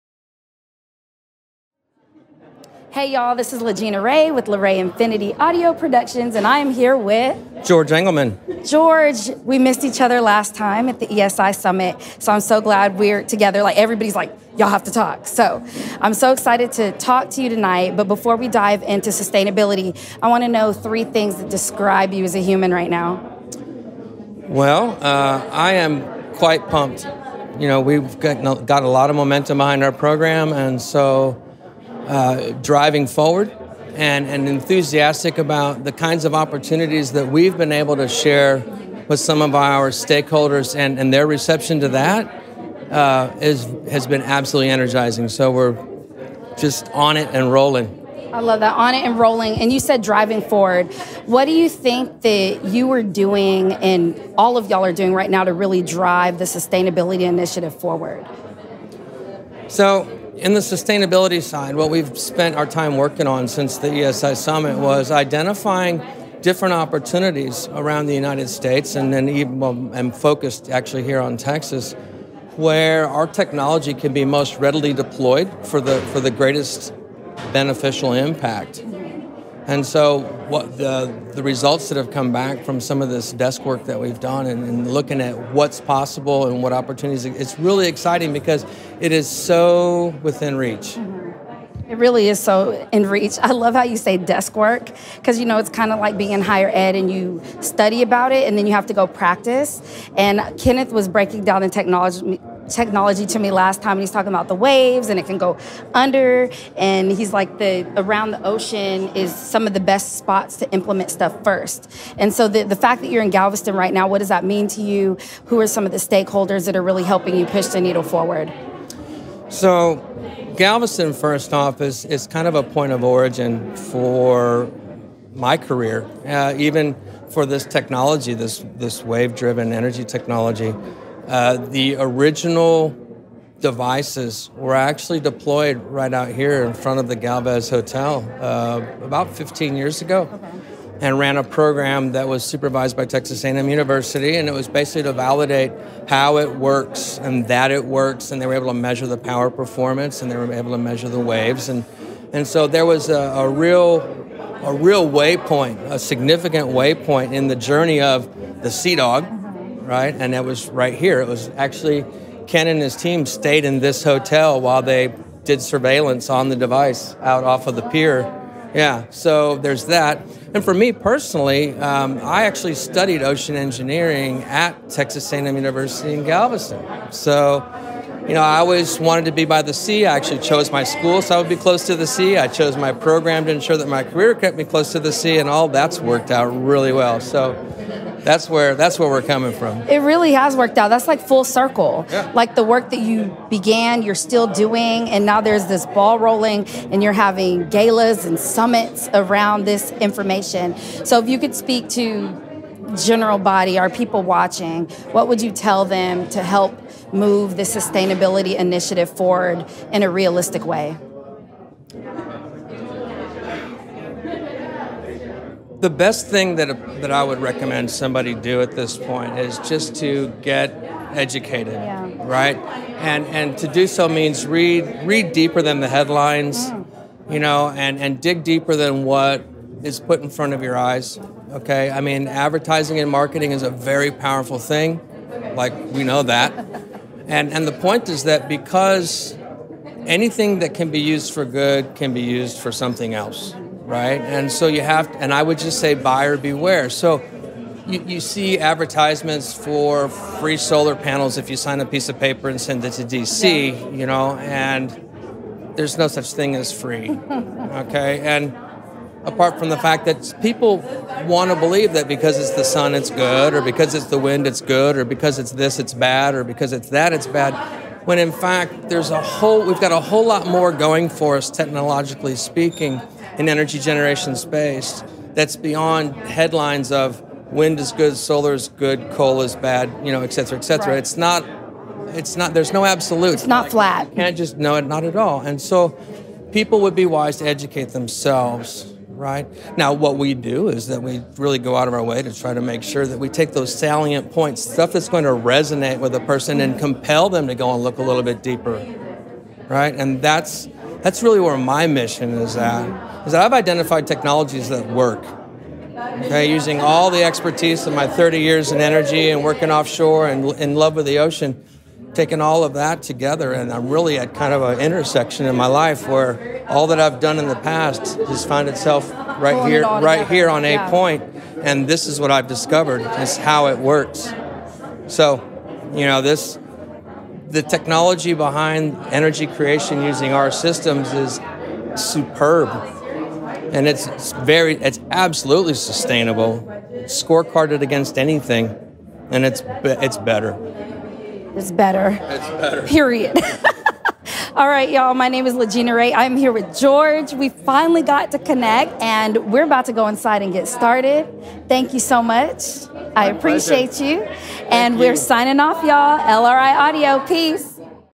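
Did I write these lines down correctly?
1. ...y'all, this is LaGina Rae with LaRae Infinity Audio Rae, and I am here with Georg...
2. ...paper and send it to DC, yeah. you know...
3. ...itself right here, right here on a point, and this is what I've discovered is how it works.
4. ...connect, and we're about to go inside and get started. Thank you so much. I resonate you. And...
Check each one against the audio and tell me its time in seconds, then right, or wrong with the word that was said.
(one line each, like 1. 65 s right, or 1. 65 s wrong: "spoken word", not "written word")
1. 3 s wrong: "Productions", not "Rae"
2. 252 s right
3. 318 s right
4. 348 s wrong: "appreciate", not "resonate".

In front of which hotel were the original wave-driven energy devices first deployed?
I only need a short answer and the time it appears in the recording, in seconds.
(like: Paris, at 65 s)
Galvez Hotel, at 137 s.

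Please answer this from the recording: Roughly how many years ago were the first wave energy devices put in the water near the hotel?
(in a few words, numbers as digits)
15 years.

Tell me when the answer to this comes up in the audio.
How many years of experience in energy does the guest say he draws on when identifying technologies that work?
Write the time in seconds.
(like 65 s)
308 s.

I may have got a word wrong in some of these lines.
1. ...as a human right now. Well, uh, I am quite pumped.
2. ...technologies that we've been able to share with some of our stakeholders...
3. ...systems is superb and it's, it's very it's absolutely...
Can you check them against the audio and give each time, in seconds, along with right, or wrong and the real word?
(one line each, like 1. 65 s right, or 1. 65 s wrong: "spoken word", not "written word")
1. 22 s right
2. 36 s wrong: "opportunities", not "technologies"
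3. 330 s right.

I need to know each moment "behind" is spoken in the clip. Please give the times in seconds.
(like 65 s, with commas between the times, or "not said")
29 s, 328 s.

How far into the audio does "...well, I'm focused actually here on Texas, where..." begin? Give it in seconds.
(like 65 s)
69 s.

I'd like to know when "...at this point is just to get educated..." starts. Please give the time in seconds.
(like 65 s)
218 s.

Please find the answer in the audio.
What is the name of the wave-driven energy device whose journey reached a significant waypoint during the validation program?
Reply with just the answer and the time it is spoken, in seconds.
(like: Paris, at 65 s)
Sea Dog, at 158 s.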